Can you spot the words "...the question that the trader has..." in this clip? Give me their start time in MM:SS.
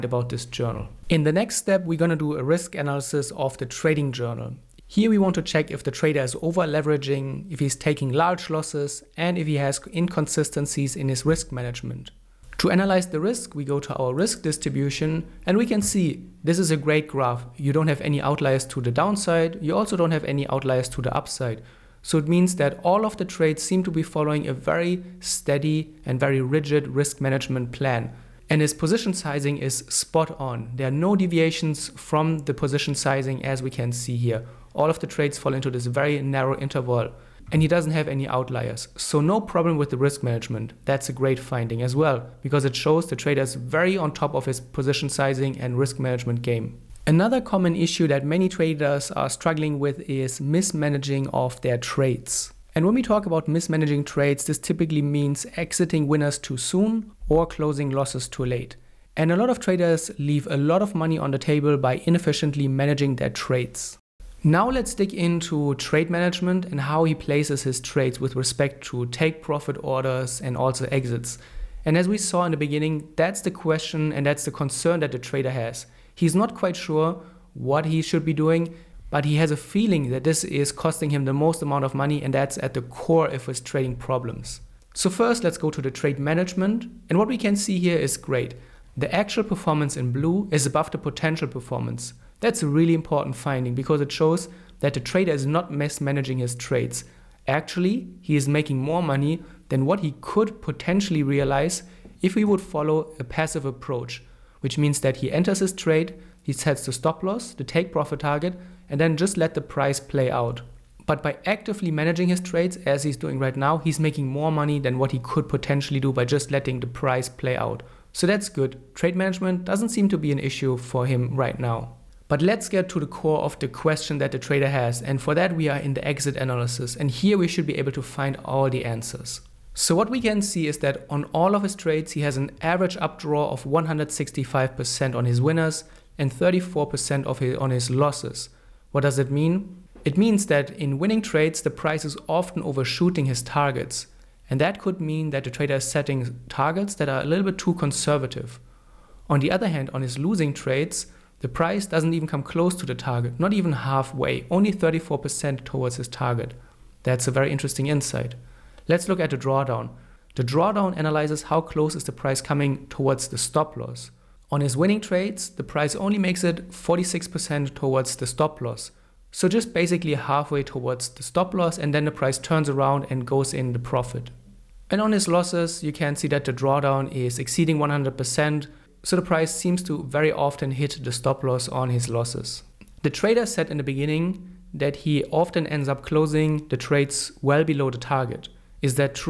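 02:03.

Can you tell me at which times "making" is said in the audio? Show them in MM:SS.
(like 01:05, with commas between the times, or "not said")
01:38, 01:53.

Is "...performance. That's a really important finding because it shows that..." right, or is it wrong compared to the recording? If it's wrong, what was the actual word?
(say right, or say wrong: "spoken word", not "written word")
right.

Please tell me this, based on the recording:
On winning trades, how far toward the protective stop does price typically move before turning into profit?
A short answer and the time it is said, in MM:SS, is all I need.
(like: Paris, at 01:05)
46%, at 02:46.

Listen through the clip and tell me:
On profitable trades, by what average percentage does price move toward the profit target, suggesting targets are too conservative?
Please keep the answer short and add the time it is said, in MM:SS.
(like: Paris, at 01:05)
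165%, at 02:13.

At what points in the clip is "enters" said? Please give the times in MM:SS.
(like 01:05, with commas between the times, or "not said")
01:45.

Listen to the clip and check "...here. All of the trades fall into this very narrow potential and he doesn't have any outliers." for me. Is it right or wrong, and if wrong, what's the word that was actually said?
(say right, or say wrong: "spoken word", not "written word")
wrong: "interval", not "potential".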